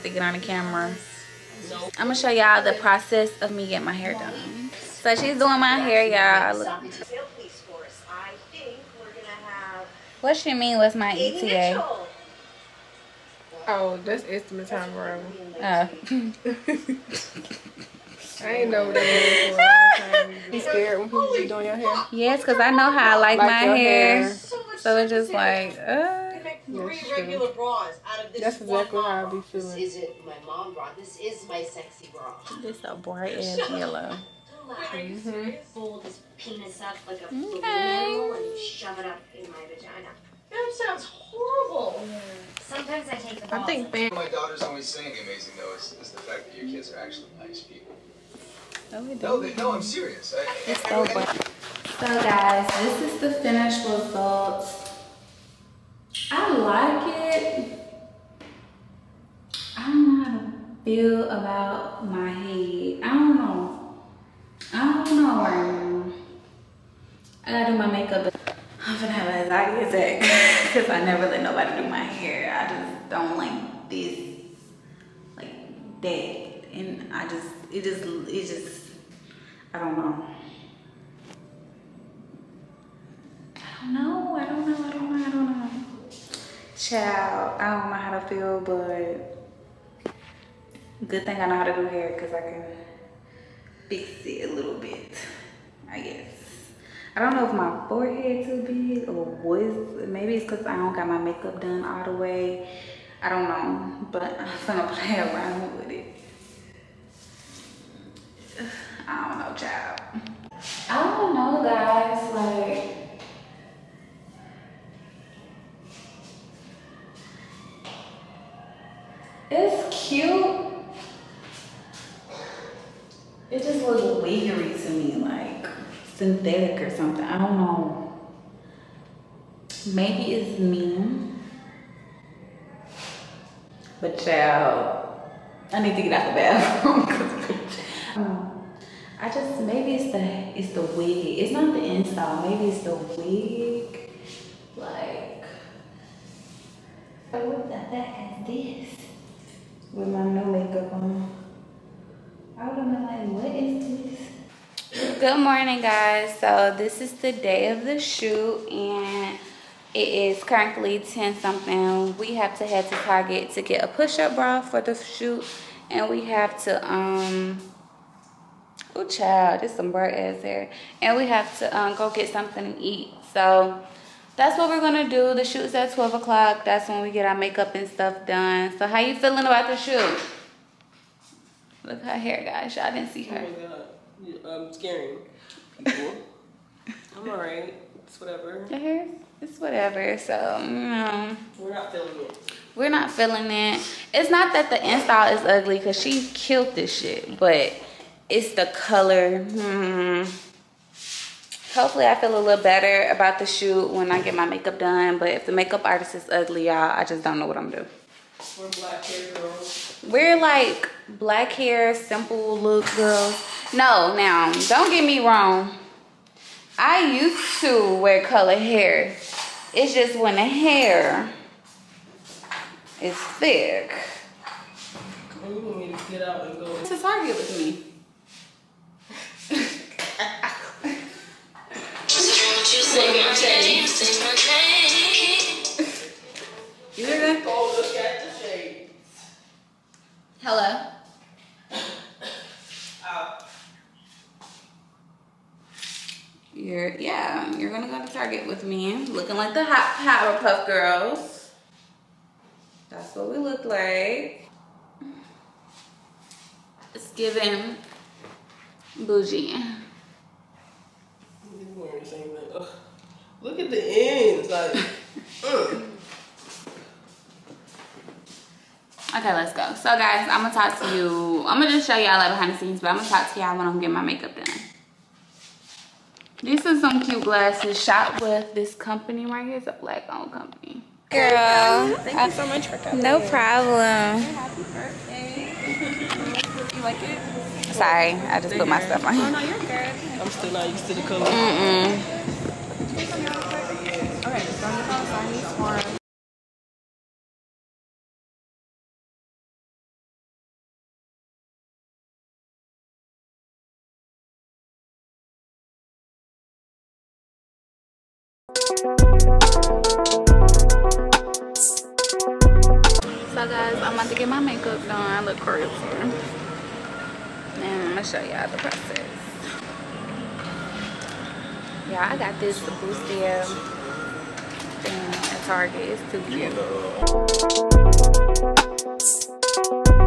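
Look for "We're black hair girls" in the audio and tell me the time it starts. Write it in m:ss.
3:28.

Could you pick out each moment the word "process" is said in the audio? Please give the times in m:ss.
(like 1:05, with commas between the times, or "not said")
0:02, 5:18.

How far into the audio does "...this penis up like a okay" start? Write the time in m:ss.
0:36.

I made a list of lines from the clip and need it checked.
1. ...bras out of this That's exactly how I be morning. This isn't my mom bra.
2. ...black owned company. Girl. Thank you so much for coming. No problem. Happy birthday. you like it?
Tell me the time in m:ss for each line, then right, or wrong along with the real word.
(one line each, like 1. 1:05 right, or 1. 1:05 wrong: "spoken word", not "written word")
1. 0:27 wrong: "feeling", not "morning"
2. 4:39 right.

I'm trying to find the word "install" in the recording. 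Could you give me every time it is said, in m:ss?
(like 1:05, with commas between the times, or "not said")
2:21, 3:14.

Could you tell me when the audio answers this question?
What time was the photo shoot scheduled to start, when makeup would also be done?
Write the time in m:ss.
2:55.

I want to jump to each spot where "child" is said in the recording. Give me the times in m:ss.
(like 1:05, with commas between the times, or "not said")
1:26, 1:49, 2:14, 2:49.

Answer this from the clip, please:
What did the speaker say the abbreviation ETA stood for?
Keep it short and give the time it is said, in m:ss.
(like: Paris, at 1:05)
estimate time arrival, at 0:14.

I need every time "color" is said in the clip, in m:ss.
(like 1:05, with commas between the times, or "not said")
3:18, 4:51.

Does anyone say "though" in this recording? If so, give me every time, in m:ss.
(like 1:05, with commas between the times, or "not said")
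0:45.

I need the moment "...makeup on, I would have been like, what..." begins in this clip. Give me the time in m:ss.
2:30.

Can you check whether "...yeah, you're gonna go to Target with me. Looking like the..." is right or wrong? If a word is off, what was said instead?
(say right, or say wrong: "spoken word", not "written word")
right.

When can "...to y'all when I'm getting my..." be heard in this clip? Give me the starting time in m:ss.
4:33.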